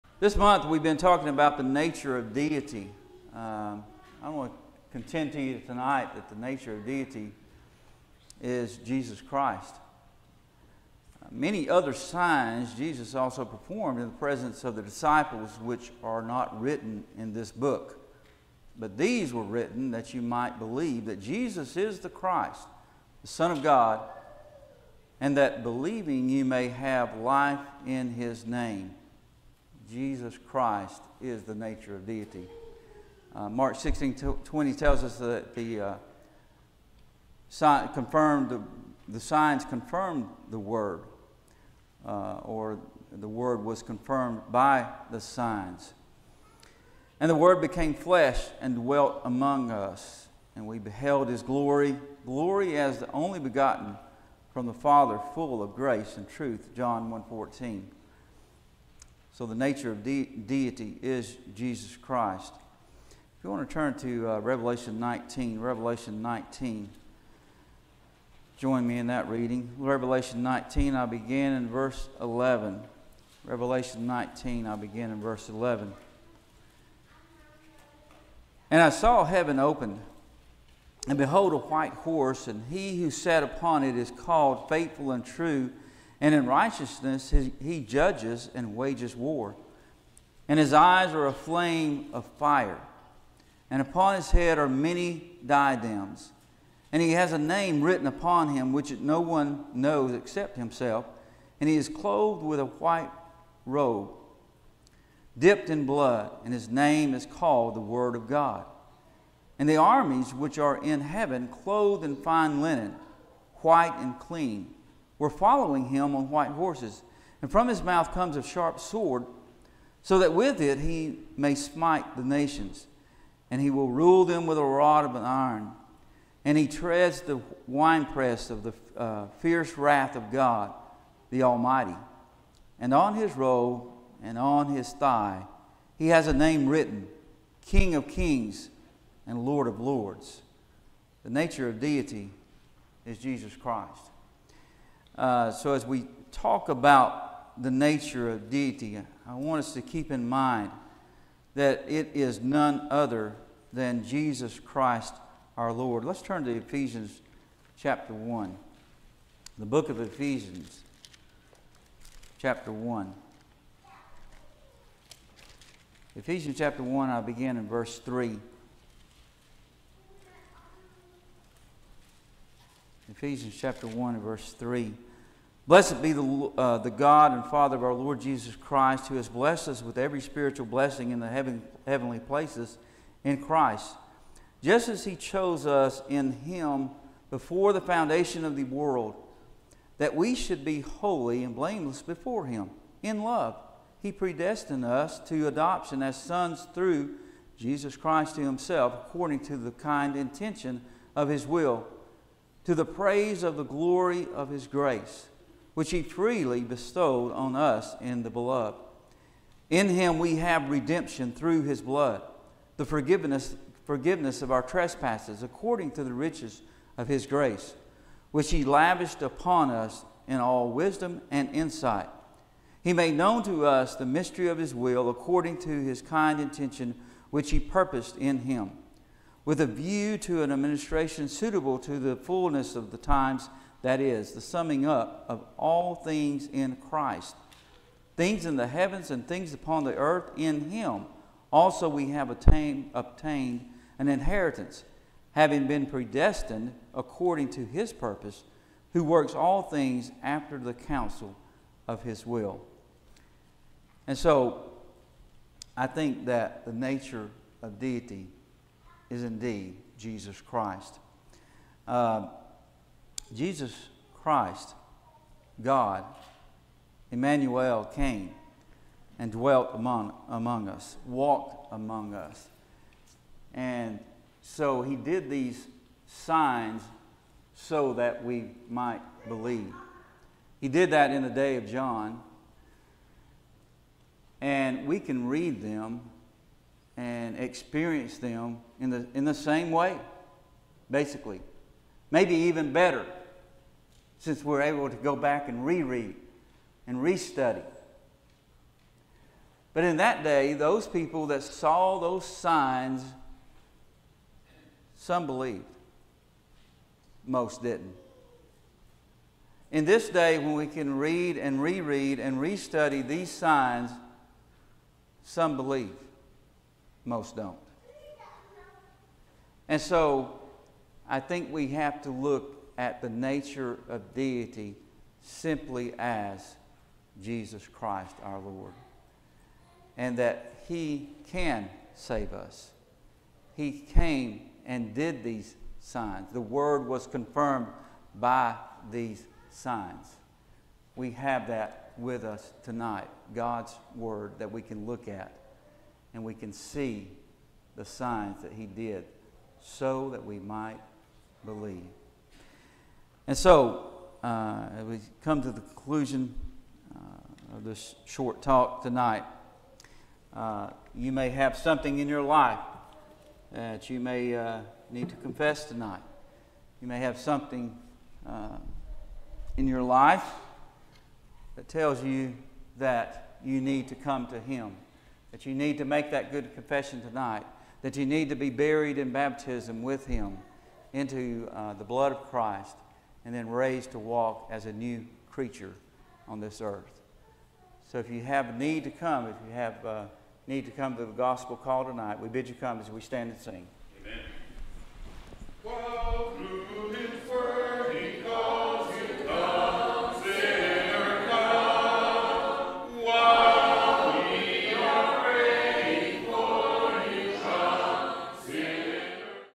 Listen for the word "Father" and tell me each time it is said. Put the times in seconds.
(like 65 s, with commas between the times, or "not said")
54 s, 177 s.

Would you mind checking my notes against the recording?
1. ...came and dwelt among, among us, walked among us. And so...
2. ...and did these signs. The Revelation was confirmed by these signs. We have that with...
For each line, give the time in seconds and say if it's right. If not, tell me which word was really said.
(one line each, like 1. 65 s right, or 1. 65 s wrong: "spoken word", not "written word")
1. 267 s right
2. 334 s wrong: "Word", not "Revelation".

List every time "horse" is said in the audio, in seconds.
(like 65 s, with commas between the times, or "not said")
81 s, 116 s.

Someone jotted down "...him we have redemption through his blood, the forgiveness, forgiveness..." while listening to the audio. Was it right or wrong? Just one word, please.
right.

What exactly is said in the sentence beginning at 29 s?
Jesus Christ is the nature of deity.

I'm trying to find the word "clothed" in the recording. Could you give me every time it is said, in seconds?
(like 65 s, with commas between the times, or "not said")
101 s, 111 s.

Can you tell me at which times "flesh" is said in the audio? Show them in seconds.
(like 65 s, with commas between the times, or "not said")
47 s.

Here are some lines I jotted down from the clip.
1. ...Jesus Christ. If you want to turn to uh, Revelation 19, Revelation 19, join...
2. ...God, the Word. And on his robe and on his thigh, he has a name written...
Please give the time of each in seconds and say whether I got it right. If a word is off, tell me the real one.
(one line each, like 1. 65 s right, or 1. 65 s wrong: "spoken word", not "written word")
1. 61 s right
2. 130 s wrong: "Almighty", not "Word".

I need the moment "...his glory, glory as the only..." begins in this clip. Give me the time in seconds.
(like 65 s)
51 s.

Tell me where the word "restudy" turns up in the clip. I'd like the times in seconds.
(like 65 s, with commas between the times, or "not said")
296 s, 312 s.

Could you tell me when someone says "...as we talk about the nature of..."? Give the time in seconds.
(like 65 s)
145 s.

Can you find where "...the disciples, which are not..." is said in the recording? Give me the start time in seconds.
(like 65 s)
14 s.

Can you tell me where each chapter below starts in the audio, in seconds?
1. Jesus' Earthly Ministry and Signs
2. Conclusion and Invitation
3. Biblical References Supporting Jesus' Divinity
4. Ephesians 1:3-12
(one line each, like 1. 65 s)
1. 254 s
2. 352 s
3. 62 s
4. 148 s.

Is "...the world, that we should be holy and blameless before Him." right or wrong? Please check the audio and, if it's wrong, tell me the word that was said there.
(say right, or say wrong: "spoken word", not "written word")
right.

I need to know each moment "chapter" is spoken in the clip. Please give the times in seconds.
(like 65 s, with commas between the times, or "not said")
157 s, 162 s, 166 s, 173 s.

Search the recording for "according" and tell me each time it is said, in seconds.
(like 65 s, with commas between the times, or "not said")
199 s, 215 s, 225 s, 246 s.